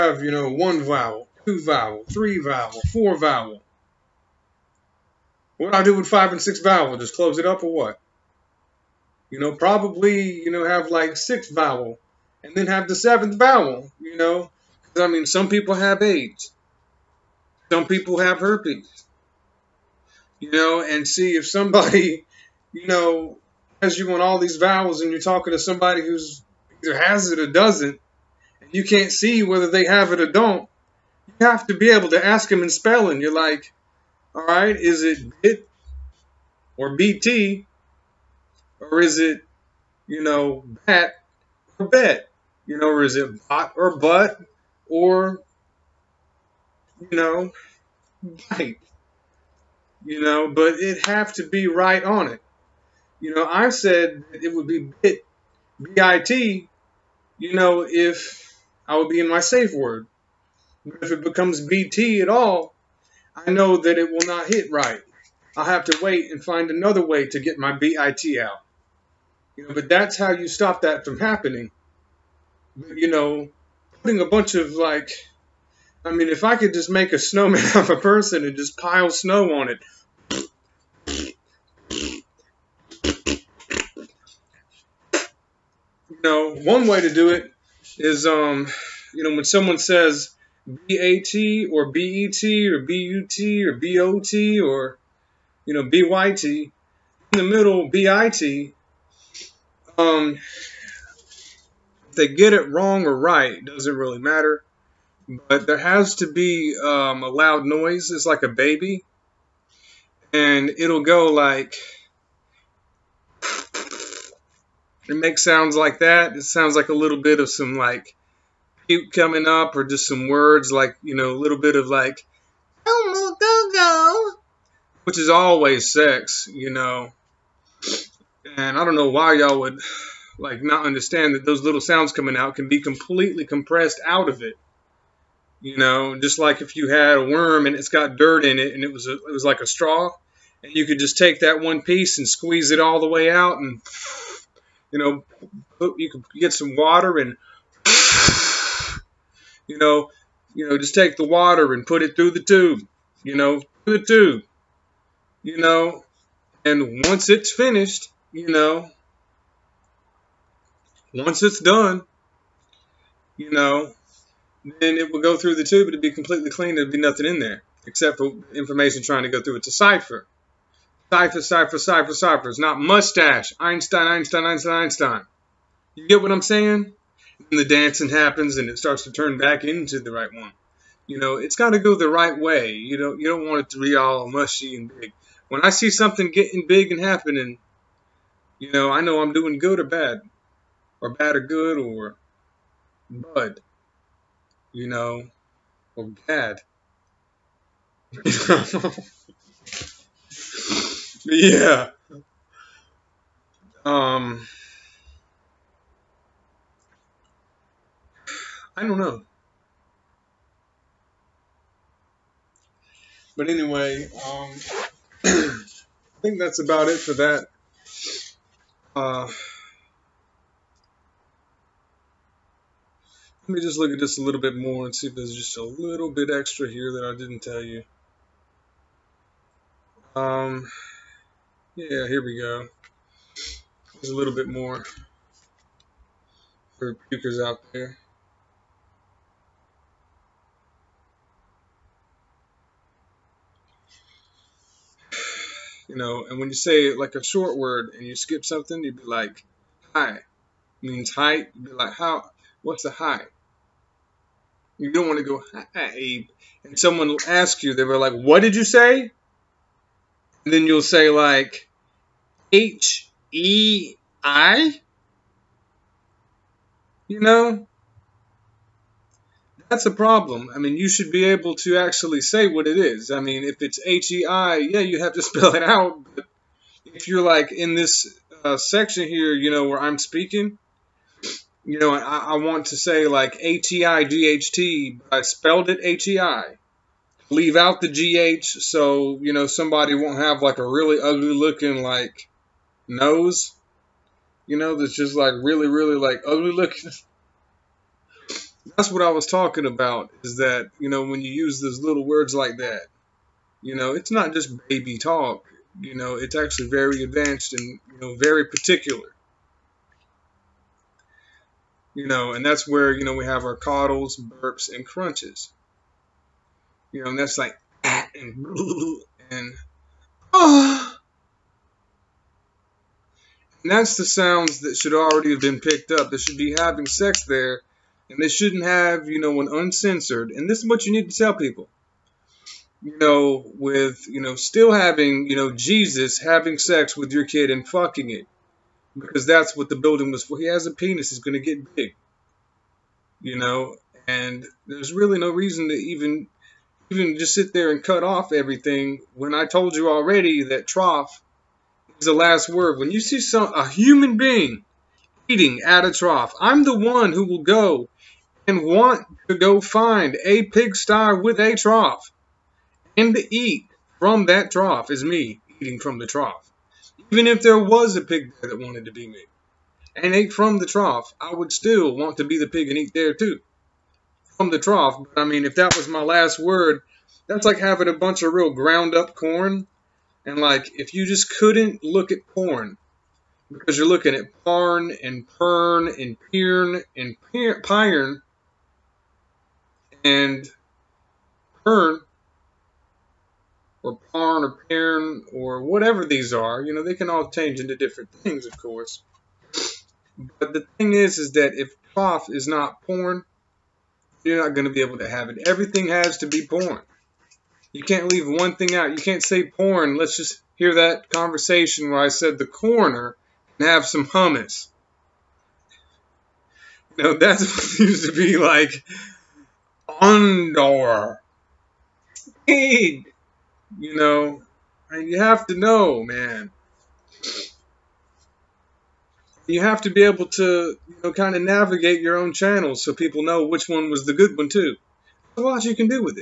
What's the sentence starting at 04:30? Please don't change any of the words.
I mean, you should be able to actually say what it is.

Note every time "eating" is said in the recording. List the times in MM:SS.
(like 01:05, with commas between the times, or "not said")
05:55, 06:05.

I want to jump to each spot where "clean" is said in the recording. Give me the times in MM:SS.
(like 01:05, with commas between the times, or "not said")
02:46.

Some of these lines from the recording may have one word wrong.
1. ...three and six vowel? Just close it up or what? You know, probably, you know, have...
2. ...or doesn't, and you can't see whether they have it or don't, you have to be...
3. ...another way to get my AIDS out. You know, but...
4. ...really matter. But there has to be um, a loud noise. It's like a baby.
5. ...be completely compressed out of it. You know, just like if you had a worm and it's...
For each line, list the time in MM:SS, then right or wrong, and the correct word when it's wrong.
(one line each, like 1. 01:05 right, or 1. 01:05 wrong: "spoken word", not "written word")
1. 00:06 wrong: "five", not "three"
2. 00:27 right
3. 01:06 wrong: "BIT", not "AIDS"
4. 01:43 right
5. 02:12 right.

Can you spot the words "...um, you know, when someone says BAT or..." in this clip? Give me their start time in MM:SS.
01:28.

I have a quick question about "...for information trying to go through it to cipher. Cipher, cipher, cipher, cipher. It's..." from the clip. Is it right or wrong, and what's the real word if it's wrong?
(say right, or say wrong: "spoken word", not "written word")
right.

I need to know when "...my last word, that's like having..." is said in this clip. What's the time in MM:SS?
06:15.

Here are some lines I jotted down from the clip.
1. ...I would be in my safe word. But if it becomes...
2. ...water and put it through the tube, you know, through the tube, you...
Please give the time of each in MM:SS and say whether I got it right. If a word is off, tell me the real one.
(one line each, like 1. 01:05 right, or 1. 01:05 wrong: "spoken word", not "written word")
1. 00:58 right
2. 02:31 right.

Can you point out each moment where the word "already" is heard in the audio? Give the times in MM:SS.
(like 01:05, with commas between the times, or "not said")
05:24, 05:49.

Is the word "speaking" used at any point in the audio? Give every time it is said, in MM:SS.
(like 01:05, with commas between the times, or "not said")
04:39.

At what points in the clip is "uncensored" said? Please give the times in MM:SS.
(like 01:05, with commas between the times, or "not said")
05:29.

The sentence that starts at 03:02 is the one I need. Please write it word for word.
You don't, you don't want it to be all mushy and big.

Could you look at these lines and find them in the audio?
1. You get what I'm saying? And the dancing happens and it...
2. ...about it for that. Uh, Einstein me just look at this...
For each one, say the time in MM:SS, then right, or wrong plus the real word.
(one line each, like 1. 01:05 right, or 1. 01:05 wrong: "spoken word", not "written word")
1. 02:55 right
2. 03:36 wrong: "Let", not "Einstein".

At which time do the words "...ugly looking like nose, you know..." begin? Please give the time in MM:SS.
04:50.